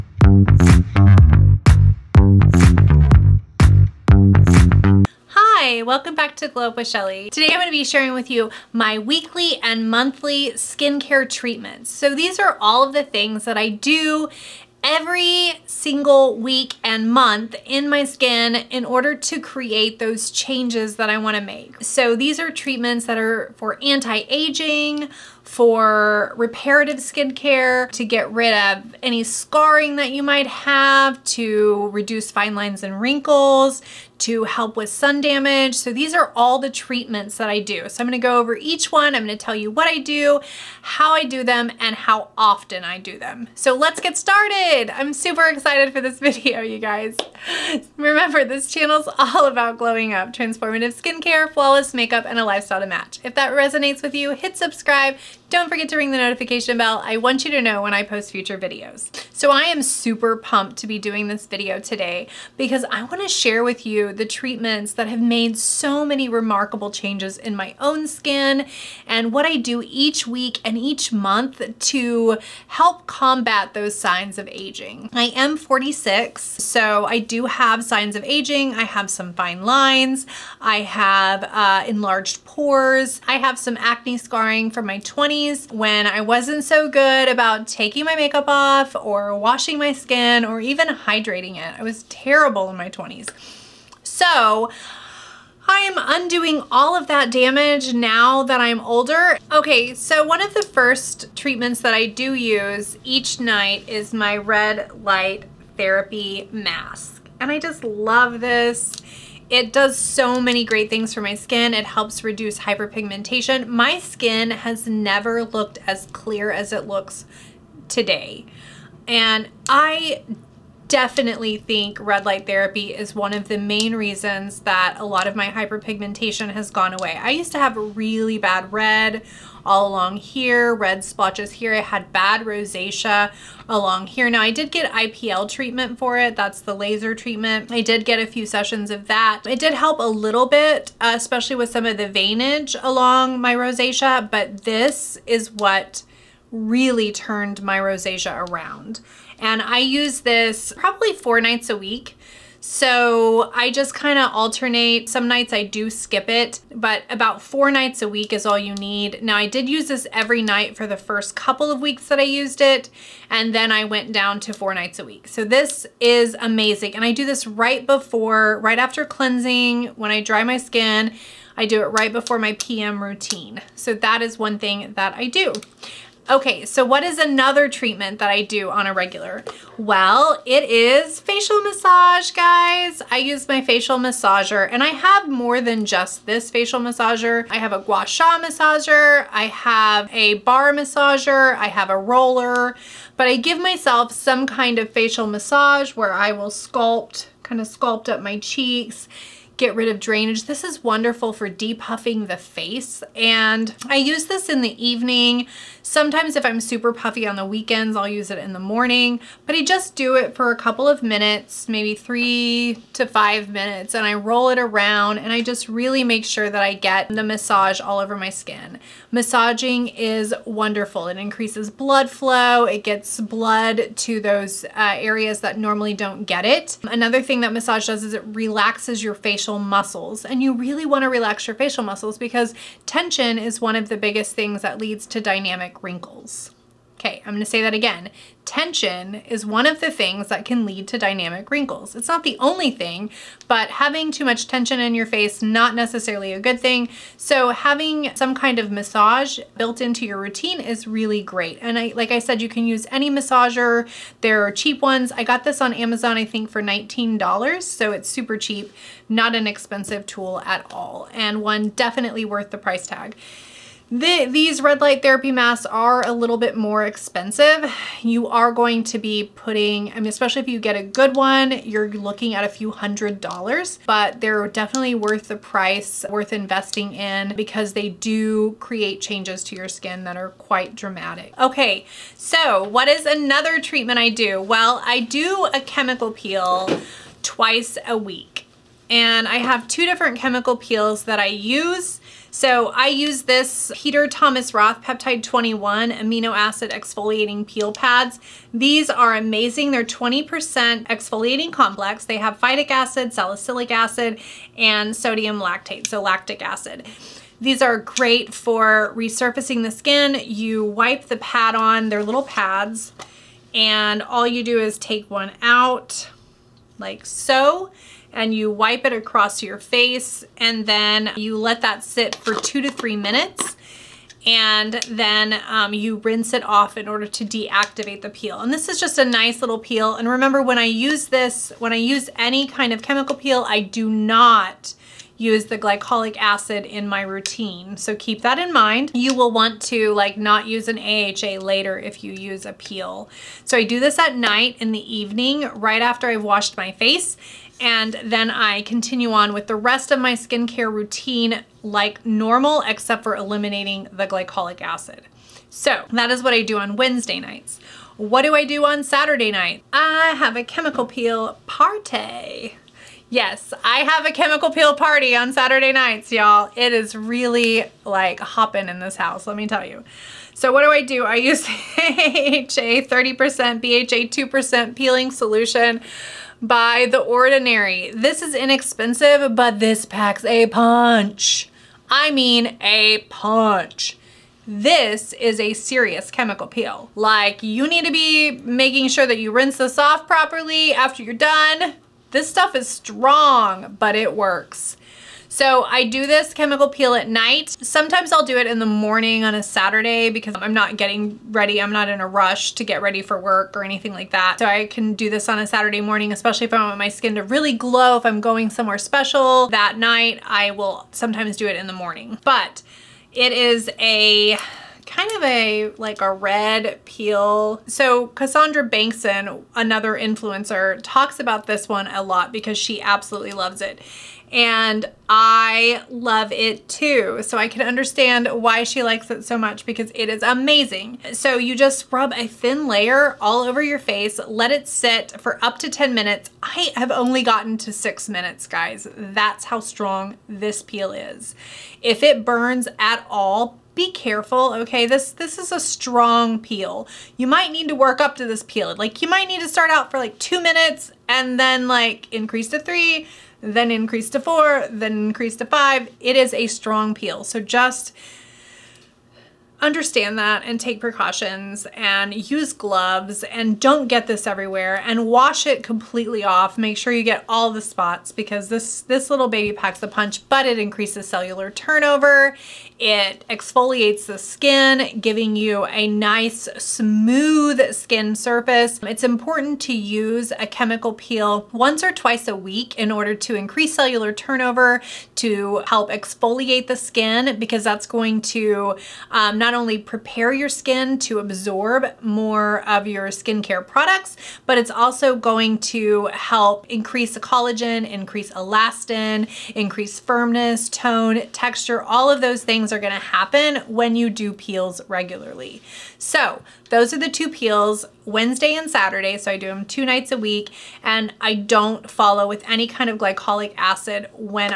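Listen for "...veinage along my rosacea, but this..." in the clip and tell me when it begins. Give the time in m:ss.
2:22.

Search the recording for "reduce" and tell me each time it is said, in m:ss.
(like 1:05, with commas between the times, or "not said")
0:31, 1:52.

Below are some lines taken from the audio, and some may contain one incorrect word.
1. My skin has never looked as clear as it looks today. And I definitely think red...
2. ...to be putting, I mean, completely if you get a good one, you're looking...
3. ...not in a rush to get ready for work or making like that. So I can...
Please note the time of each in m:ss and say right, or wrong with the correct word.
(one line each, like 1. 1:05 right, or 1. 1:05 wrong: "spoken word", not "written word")
1. 1:53 right
2. 4:28 wrong: "especially", not "completely"
3. 6:41 wrong: "anything", not "making".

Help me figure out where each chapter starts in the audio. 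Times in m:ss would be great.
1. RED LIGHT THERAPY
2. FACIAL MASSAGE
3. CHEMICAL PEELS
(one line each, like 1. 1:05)
1. 1:43
2. 3:01
3. 4:47.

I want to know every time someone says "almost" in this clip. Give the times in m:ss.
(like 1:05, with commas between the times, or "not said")
not said.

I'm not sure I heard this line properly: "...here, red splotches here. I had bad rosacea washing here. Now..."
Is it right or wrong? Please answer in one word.
wrong.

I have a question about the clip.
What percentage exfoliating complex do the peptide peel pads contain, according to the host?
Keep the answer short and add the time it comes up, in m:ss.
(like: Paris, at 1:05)
20%, at 4:59.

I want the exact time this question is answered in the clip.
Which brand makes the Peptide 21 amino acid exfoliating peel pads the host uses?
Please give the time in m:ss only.
4:53.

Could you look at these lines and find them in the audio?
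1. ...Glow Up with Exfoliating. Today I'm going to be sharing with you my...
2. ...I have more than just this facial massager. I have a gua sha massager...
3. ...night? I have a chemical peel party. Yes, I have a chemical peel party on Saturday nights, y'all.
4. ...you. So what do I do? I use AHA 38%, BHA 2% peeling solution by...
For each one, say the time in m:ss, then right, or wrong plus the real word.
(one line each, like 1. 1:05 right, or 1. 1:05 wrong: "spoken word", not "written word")
1. 0:06 wrong: "Shelley", not "Exfoliating"
2. 3:04 right
3. 5:59 right
4. 6:09 wrong: "30", not "38".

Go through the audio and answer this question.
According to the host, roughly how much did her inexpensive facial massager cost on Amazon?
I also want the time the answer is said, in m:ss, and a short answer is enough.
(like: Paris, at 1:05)
$19, at 4:16.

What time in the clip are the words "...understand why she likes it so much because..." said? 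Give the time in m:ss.
7:07.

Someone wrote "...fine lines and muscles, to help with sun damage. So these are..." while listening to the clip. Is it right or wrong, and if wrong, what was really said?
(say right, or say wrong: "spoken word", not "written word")
wrong: "wrinkles", not "muscles".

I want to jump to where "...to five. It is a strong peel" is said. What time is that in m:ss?
7:35.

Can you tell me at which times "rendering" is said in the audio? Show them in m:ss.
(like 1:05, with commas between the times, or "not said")
not said.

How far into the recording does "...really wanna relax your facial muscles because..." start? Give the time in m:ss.
3:50.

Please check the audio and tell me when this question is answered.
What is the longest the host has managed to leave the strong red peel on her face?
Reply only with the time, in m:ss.
7:17.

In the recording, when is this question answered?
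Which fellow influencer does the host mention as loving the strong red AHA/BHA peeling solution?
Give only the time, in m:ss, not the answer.
6:58.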